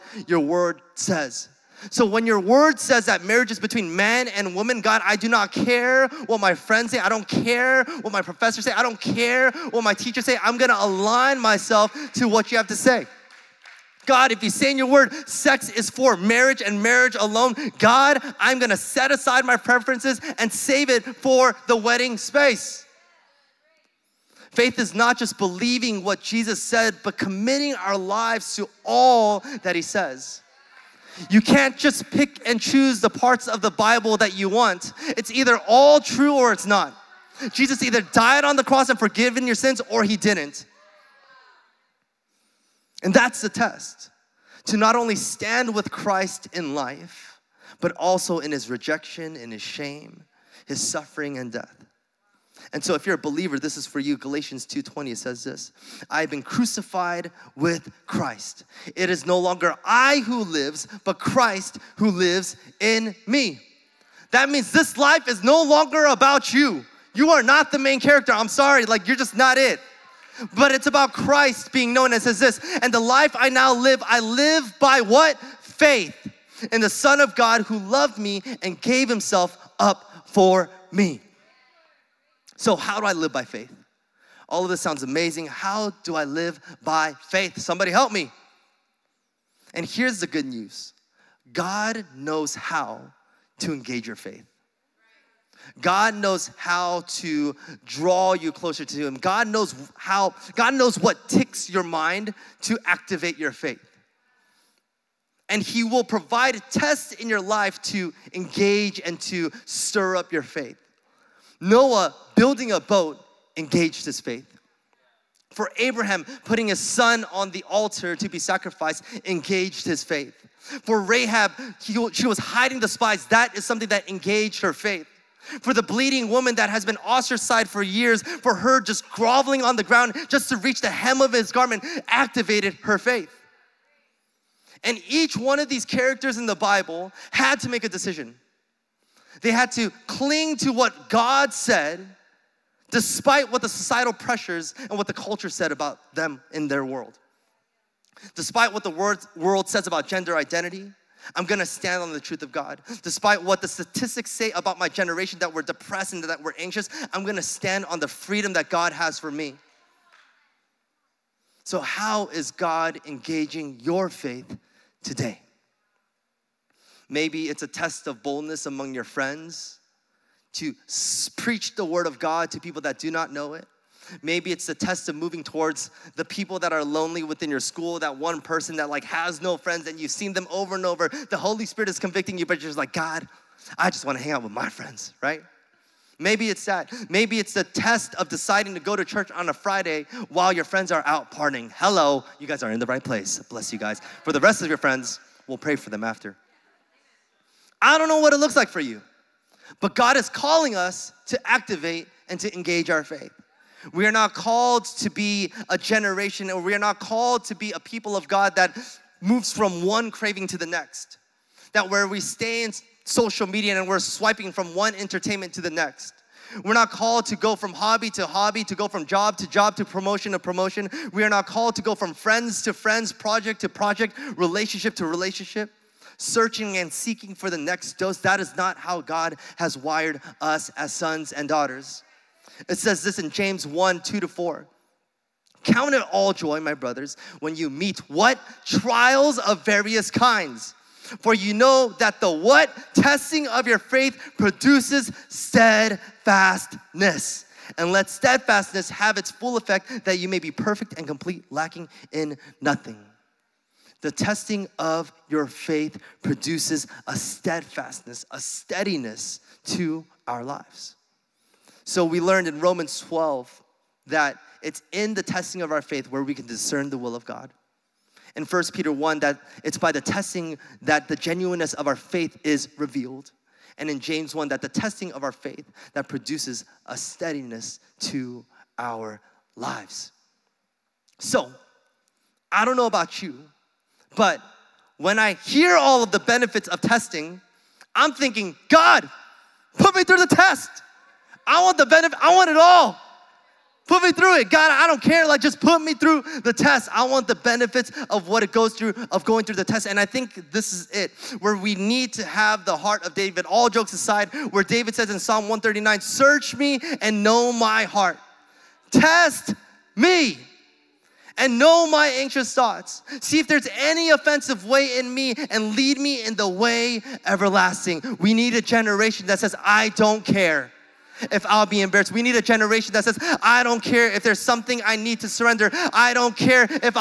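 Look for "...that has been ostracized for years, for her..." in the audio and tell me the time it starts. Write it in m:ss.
2:06.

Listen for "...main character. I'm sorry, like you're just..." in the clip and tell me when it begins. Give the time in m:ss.
1:07.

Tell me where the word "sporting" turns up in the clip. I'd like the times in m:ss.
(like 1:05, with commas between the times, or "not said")
not said.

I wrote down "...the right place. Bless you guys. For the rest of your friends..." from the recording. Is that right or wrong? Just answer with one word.
right.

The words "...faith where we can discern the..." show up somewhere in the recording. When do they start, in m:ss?
4:25.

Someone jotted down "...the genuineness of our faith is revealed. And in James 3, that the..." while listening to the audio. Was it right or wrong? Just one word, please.
wrong.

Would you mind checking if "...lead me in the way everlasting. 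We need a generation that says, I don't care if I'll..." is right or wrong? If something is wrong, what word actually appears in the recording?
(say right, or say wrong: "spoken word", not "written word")
right.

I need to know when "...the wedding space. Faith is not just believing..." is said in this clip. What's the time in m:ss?
0:21.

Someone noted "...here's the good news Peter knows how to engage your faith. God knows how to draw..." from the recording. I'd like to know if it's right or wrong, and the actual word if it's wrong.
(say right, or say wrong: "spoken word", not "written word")
wrong: "God", not "Peter".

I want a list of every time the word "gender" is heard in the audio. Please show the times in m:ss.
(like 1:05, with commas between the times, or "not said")
2:30.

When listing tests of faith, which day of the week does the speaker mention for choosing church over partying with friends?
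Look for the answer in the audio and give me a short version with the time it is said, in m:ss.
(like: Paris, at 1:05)
Friday, at 3:09.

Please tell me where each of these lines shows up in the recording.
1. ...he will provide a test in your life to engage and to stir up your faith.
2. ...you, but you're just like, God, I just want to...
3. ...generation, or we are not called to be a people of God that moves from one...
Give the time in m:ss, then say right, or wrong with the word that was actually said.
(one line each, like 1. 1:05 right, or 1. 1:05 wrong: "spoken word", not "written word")
1. 1:45 right
2. 3:02 right
3. 3:25 right.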